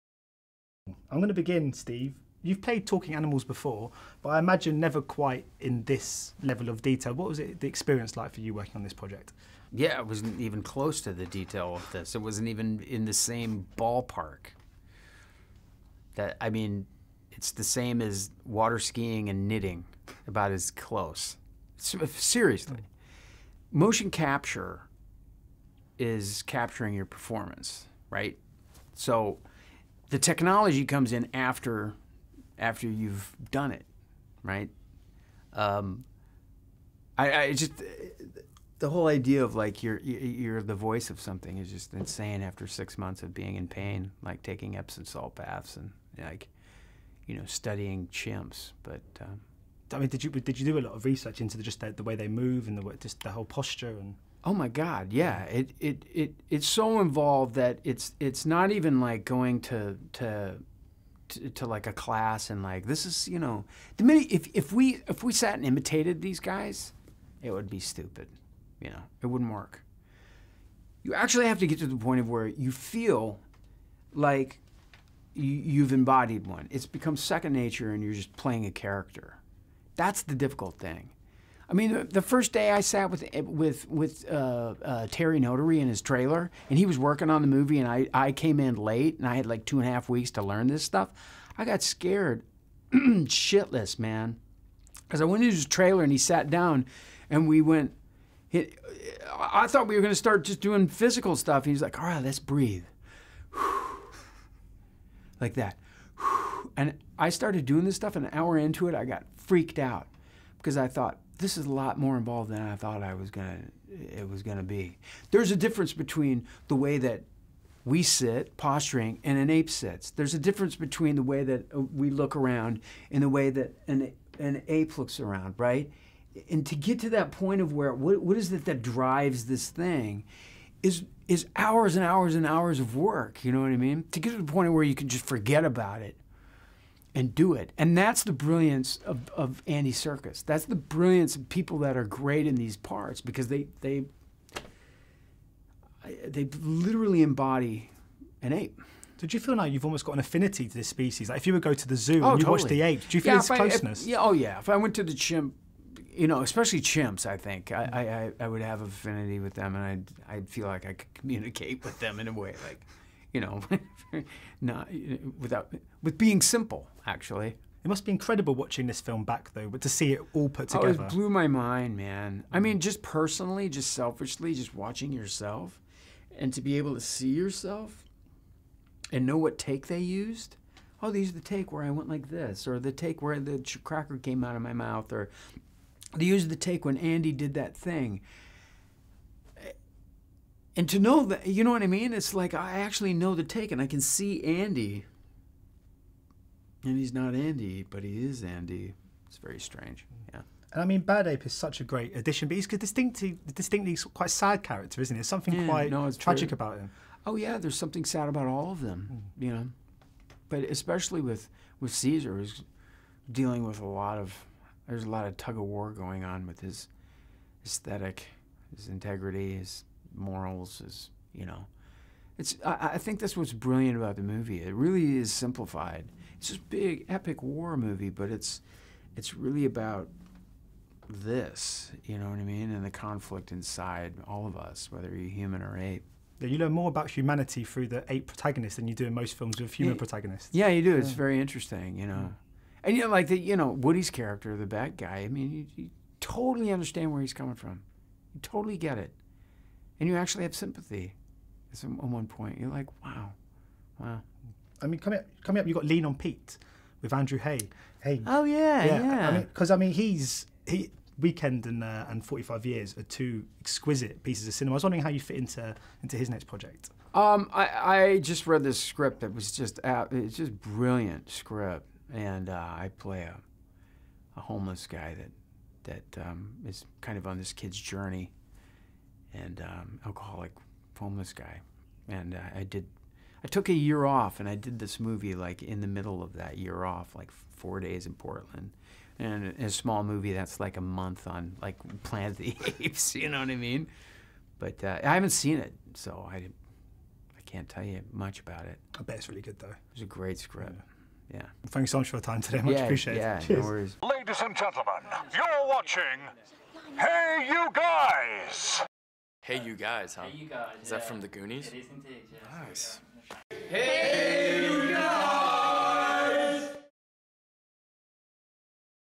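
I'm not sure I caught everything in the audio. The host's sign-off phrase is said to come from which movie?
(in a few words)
The Goonies.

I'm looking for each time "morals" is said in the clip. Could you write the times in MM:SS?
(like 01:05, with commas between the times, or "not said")
03:40.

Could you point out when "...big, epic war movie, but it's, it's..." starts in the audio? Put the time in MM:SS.
03:46.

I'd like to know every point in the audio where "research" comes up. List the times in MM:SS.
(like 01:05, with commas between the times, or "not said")
00:51.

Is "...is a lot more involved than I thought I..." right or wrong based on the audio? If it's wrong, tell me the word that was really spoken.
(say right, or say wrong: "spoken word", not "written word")
right.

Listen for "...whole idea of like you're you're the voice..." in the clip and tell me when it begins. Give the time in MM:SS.
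00:38.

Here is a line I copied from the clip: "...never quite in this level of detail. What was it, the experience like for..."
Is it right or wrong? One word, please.
right.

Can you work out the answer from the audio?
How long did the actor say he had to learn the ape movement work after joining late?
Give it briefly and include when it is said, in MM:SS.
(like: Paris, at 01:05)
two and a half weeks, at 01:29.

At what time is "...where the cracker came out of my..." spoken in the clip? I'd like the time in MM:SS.
03:03.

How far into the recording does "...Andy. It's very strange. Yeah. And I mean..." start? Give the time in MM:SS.
03:18.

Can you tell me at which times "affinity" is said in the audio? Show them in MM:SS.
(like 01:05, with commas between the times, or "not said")
02:30, 02:38.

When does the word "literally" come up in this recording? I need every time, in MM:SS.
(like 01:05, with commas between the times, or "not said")
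02:26.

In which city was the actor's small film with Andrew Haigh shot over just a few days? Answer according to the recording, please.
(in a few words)
Portland.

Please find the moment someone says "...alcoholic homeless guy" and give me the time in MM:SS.
04:40.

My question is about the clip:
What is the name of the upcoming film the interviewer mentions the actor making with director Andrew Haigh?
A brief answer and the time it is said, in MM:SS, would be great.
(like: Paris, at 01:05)
Lean on Pete, at 04:15.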